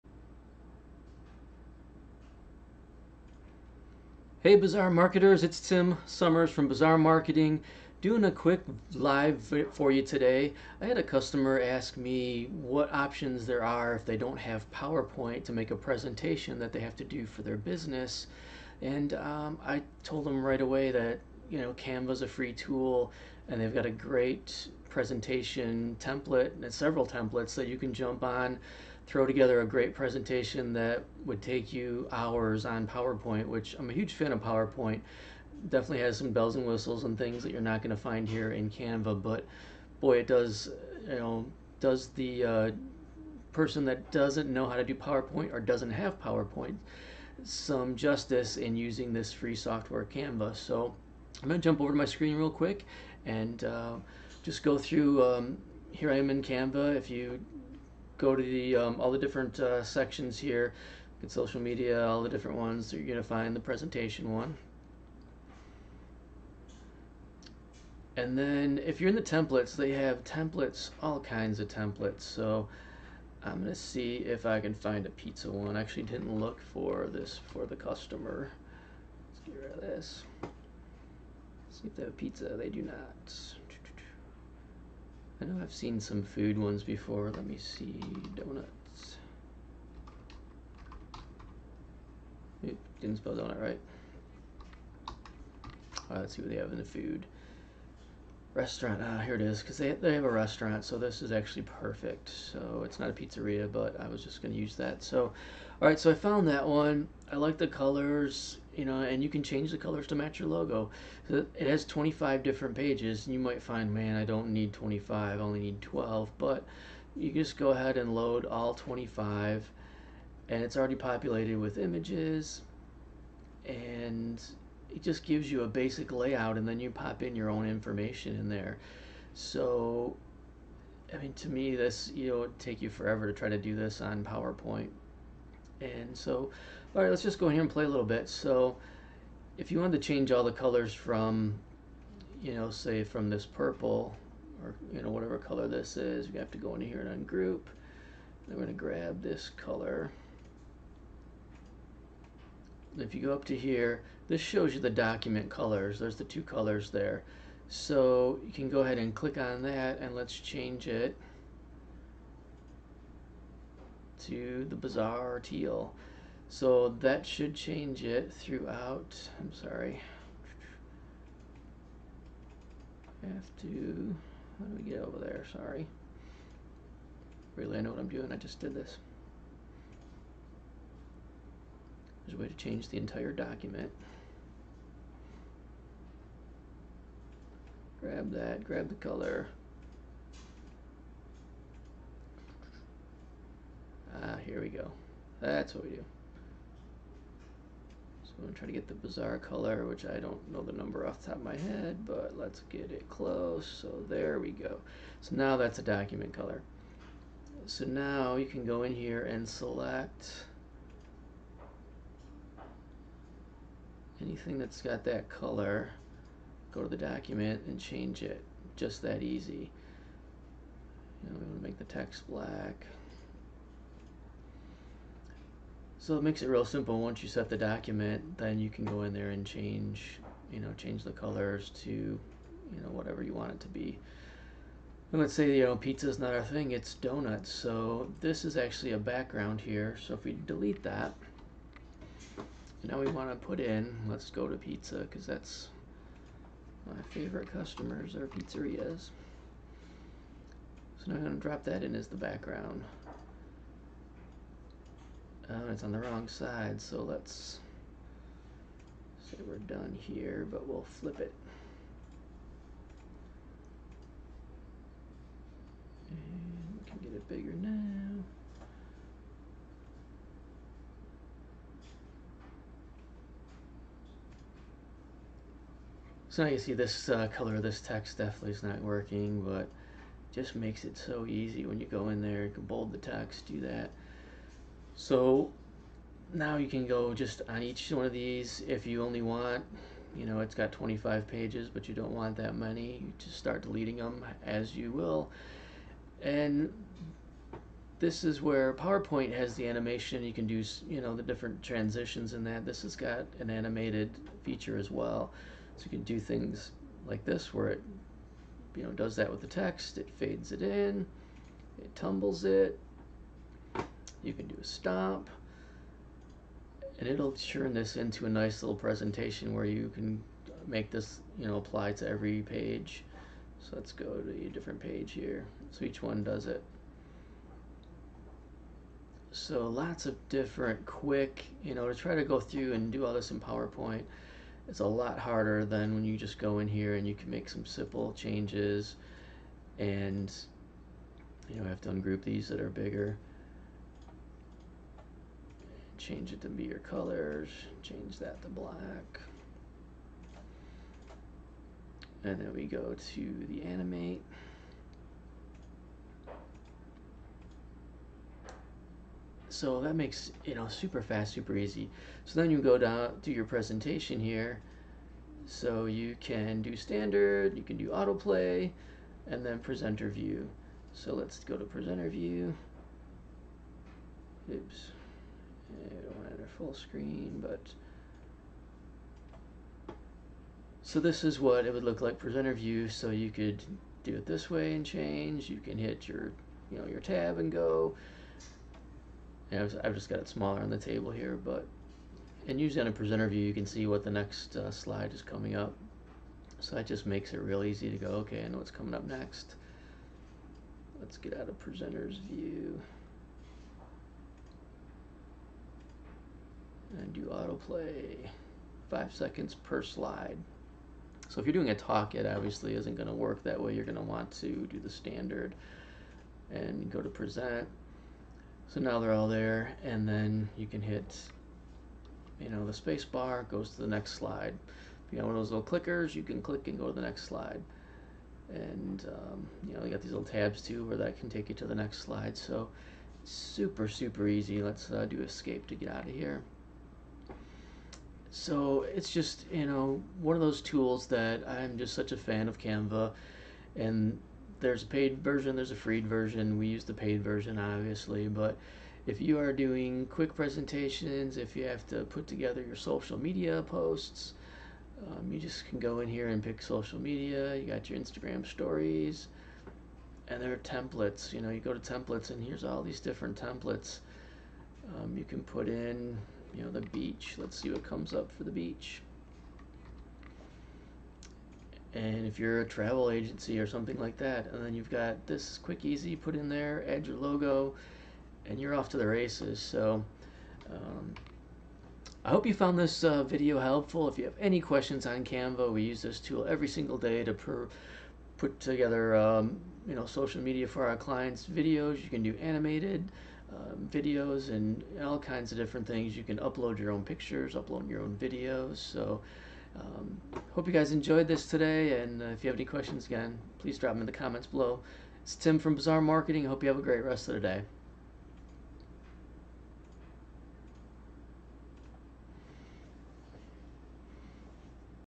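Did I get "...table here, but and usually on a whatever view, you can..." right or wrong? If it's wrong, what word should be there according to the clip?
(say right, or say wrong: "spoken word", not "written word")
wrong: "presenter", not "whatever".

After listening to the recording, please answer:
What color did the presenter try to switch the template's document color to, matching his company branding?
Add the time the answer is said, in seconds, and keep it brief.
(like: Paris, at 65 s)
bizarre teal, at 164 s.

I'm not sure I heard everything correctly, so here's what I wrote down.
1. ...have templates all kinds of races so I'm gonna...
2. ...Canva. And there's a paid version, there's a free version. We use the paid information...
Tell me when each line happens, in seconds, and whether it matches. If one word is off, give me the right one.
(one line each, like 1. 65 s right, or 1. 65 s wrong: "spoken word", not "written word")
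1. 69 s wrong: "templates", not "races"
2. 442 s wrong: "version", not "information".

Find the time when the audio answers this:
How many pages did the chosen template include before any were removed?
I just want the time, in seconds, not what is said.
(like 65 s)
111 s.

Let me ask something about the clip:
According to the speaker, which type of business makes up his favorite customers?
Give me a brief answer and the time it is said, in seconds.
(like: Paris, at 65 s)
pizzerias, at 248 s.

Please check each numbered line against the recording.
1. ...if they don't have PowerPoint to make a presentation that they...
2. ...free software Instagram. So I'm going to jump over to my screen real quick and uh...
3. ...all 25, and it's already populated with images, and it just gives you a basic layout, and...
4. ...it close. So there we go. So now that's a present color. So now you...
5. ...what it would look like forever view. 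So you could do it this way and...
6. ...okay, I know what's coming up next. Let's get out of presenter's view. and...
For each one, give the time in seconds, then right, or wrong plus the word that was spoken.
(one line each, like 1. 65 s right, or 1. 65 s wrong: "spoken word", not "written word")
1. 13 s right
2. 49 s wrong: "Canva", not "Instagram"
3. 118 s right
4. 202 s wrong: "document", not "present"
5. 381 s wrong: "presenter", not "forever"
6. 398 s right.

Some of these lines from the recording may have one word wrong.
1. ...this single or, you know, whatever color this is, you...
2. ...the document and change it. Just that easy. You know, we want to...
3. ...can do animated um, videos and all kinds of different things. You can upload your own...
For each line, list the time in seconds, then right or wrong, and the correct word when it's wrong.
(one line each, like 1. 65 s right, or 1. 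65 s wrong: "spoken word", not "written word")
1. 143 s wrong: "purple", not "single"
2. 216 s right
3. 492 s right.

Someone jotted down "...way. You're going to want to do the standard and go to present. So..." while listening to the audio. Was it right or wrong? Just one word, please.
right.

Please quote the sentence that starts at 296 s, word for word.
And this is where PowerPoint has the animation.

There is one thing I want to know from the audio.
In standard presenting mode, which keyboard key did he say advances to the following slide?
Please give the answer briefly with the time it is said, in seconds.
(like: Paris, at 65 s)
space bar, at 422 s.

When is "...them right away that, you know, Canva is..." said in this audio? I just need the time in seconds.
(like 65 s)
20 s.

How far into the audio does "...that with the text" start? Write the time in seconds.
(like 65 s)
309 s.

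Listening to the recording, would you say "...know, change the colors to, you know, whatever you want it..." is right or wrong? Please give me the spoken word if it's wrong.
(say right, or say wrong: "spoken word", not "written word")
right.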